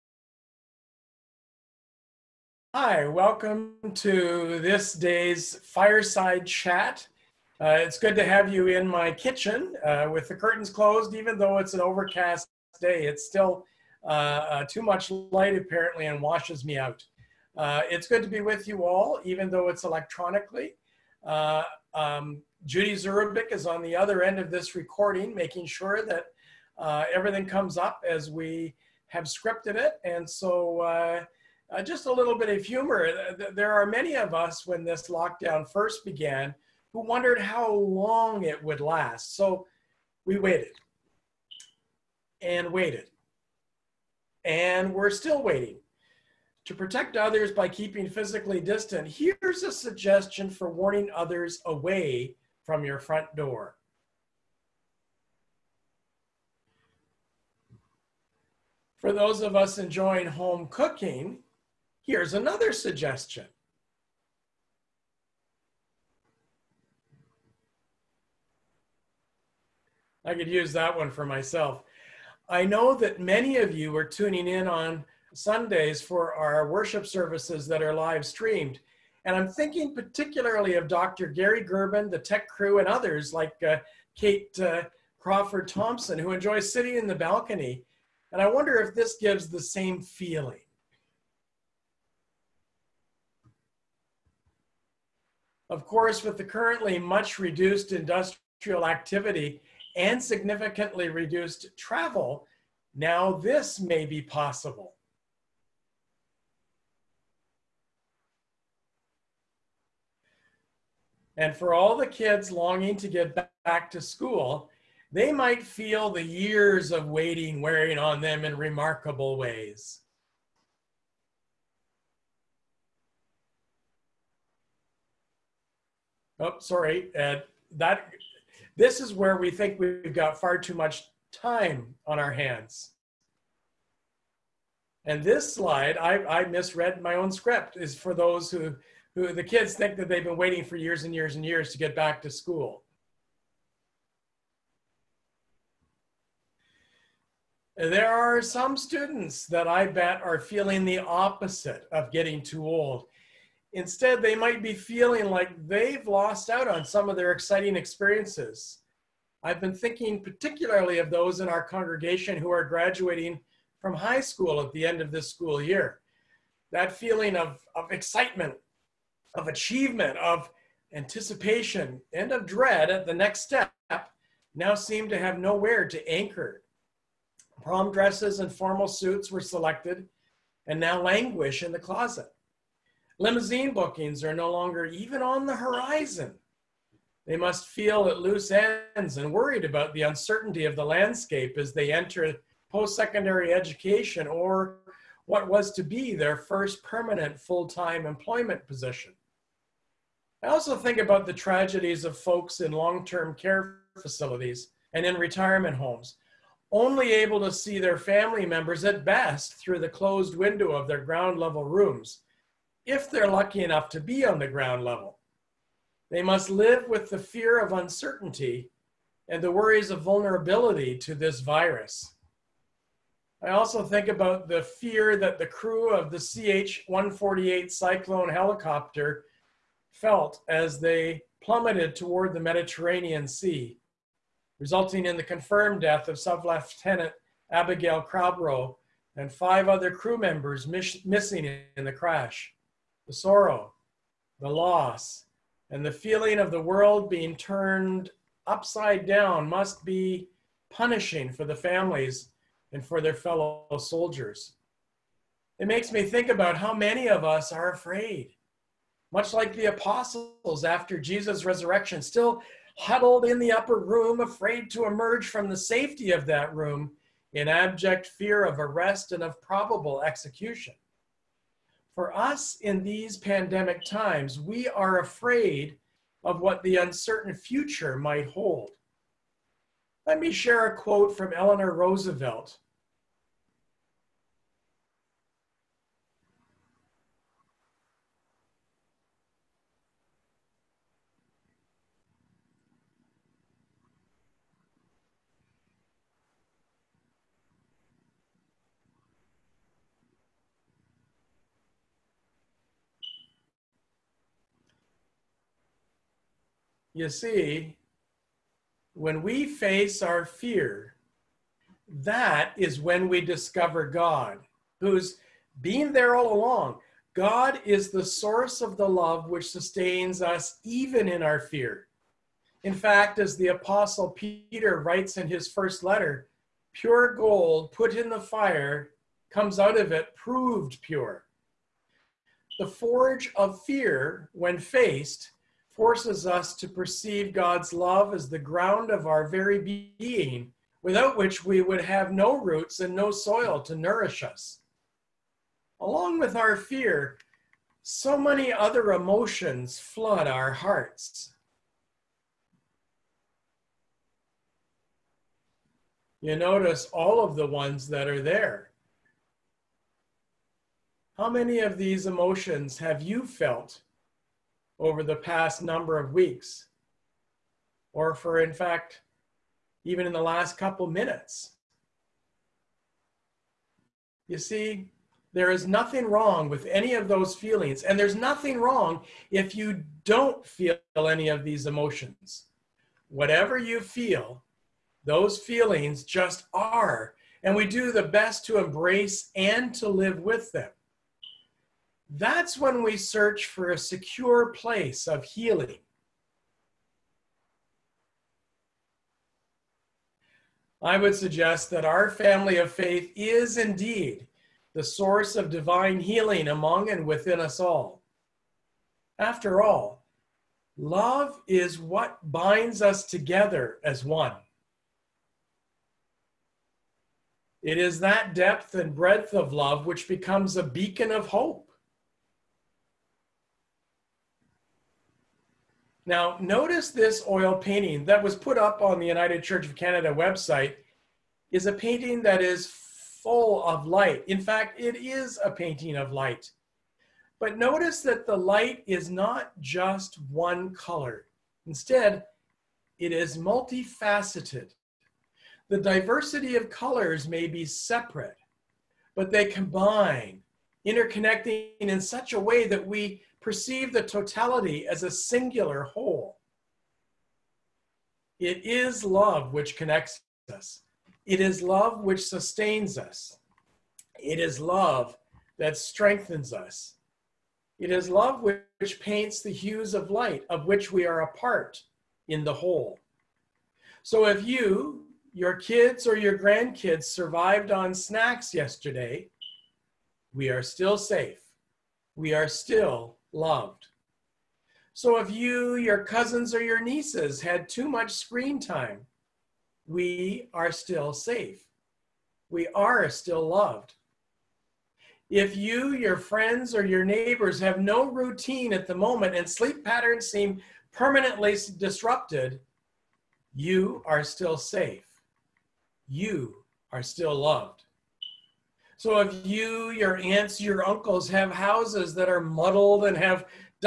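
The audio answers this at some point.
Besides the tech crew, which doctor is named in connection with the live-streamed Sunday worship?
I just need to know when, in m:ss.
1:20.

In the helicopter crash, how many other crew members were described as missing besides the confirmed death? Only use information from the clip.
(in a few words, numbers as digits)
5.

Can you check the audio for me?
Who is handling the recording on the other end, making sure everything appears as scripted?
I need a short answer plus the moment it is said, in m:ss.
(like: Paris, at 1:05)
Judy Zurabik, at 0:22.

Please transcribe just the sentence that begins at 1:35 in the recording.
Of course, with the currently much reduced industrial activity and significantly reduced travel, now this may be possible.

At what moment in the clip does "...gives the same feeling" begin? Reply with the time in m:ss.
1:29.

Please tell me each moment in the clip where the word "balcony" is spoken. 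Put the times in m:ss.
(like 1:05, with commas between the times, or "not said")
1:27.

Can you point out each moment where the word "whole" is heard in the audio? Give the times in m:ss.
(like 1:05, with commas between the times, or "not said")
7:35, 7:52.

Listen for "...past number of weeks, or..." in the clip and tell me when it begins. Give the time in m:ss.
6:05.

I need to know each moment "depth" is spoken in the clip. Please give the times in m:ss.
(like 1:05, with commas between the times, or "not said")
6:58.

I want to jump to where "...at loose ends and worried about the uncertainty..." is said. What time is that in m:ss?
3:08.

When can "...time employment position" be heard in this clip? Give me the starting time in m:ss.
3:17.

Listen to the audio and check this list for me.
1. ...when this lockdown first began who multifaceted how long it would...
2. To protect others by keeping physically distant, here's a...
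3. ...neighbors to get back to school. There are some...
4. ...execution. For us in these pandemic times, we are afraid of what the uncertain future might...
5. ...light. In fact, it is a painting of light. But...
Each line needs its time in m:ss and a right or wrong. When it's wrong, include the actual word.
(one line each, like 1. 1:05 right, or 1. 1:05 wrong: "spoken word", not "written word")
1. 0:34 wrong: "wondered", not "multifaceted"
2. 0:46 right
3. 2:21 wrong: "years", not "neighbors"
4. 4:30 right
5. 7:13 right.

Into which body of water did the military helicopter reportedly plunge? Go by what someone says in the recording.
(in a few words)
Mediterranean Sea.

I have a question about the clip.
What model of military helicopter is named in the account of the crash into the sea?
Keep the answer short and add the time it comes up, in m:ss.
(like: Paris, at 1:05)
CH 148 Cyclone, at 3:46.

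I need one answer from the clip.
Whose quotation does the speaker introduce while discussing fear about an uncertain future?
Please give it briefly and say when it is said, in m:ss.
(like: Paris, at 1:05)
Eleanor Roosevelt, at 4:41.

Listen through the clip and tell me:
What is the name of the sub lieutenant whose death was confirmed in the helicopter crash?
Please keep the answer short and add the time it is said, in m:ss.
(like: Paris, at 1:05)
Abbigail Cowbrough, at 3:57.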